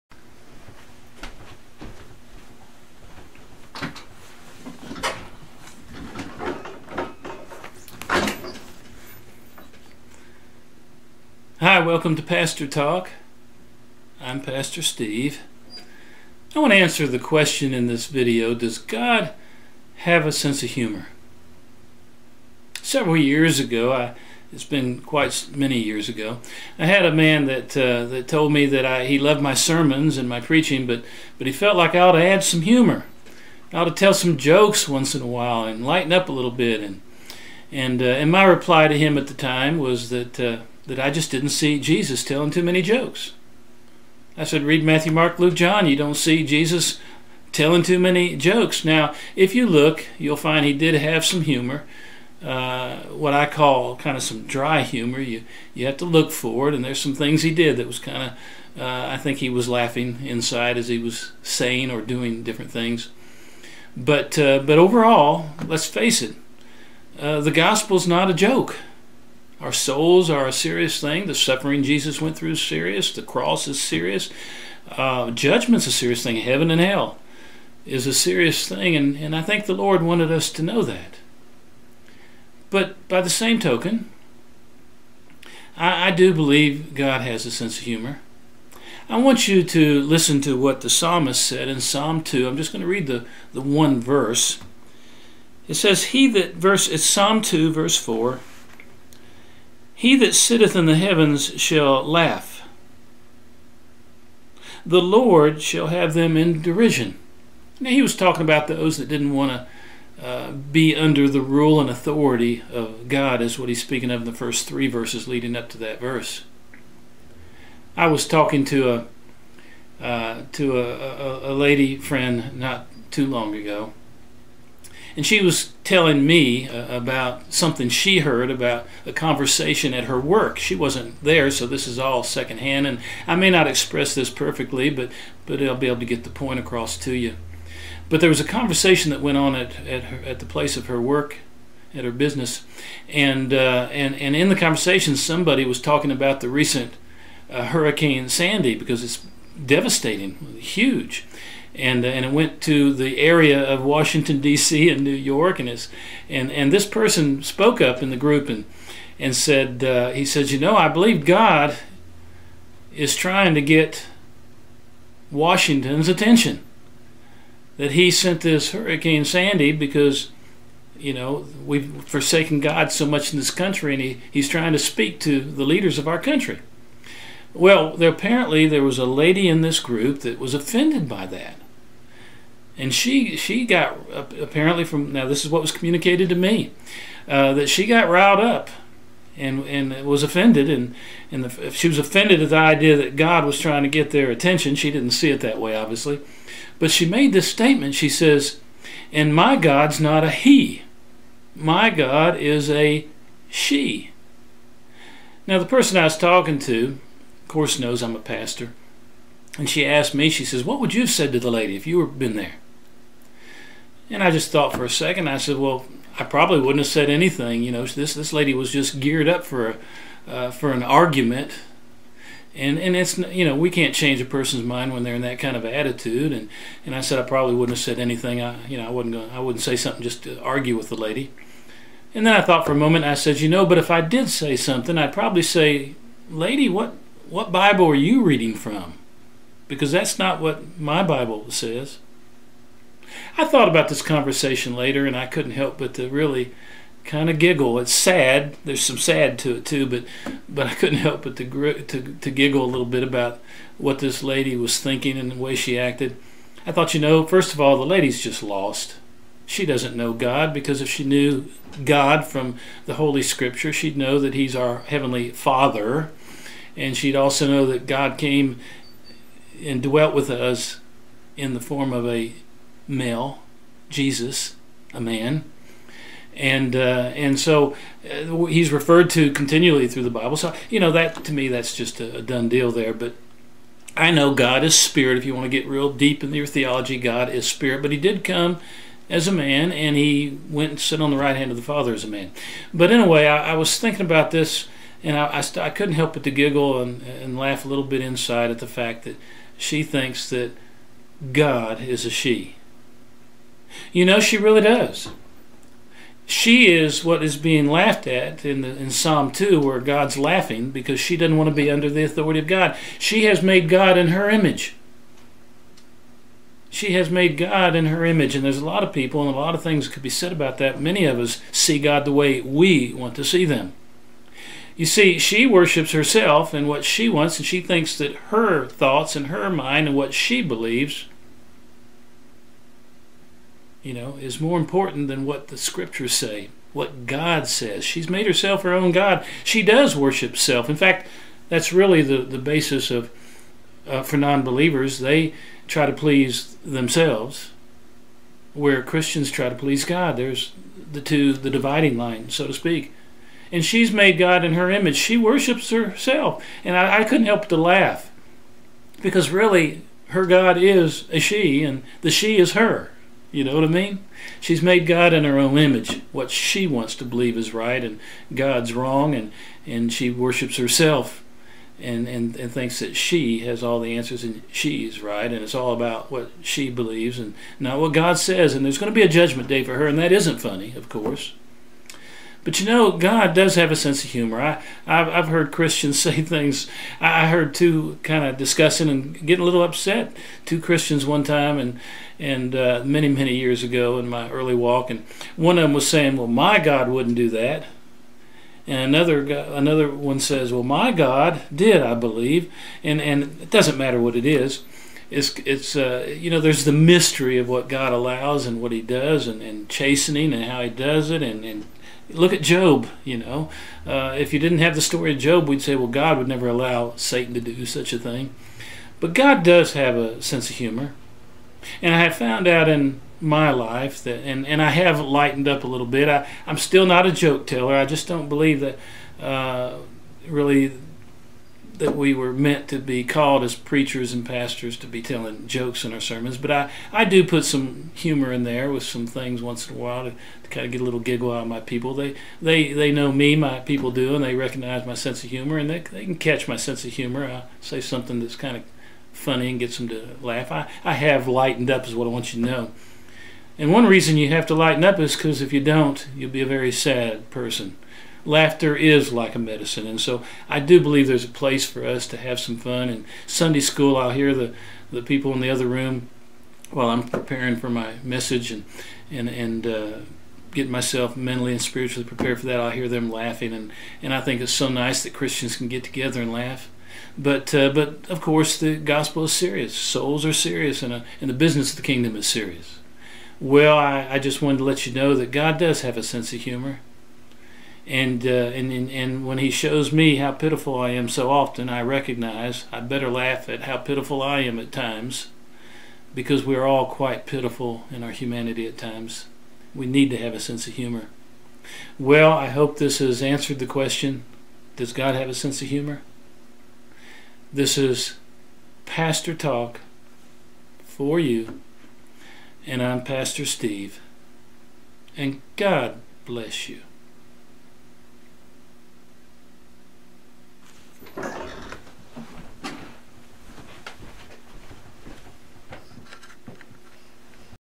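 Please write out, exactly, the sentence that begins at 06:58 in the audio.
But God does have a sense of humor.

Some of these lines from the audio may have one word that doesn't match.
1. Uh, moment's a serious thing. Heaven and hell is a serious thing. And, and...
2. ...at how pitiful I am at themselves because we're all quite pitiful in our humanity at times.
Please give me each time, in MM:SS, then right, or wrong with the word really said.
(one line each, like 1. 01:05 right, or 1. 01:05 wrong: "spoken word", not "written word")
1. 01:14 wrong: "judgment", not "moment"
2. 08:13 wrong: "times", not "themselves".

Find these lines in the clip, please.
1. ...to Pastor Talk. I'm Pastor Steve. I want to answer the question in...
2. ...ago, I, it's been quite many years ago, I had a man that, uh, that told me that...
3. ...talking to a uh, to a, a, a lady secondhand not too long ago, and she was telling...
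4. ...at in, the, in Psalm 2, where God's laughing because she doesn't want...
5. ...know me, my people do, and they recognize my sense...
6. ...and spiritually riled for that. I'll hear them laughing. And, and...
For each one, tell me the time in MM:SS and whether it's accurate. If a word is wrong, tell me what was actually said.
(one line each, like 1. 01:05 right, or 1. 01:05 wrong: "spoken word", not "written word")
1. 00:12 right
2. 00:23 right
3. 01:58 wrong: "friend", not "secondhand"
4. 05:08 right
5. 07:22 right
6. 07:51 wrong: "prepared", not "riled".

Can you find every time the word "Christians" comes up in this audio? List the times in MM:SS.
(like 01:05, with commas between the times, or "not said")
05:48, 06:25, 06:30, 07:55.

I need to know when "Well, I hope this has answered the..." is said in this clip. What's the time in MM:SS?
08:21.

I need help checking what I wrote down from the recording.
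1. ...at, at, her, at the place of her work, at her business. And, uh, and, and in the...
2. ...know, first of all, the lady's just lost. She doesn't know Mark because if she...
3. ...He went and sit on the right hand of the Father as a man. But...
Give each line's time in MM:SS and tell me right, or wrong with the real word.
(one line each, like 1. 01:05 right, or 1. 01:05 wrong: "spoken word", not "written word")
1. 02:19 right
2. 04:16 wrong: "God", not "Mark"
3. 04:49 right.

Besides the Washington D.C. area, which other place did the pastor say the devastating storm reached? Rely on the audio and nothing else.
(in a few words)
New York.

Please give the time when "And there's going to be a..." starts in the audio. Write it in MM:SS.
06:18.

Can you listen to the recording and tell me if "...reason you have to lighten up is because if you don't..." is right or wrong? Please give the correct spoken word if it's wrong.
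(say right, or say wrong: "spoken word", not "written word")
right.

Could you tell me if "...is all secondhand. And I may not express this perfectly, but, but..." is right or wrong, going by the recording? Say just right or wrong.
right.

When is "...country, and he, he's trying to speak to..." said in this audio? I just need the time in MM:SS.
02:53.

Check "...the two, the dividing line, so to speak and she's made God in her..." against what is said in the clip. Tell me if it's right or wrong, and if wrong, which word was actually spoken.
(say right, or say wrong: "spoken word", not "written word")
right.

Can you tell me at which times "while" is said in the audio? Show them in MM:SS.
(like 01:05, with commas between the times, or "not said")
00:35, 07:19, 07:46.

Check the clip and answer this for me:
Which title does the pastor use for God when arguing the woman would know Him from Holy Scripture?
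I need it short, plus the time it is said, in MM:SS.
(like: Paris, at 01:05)
Heavenly Father, at 04:24.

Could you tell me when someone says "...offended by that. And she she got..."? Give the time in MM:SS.
03:00.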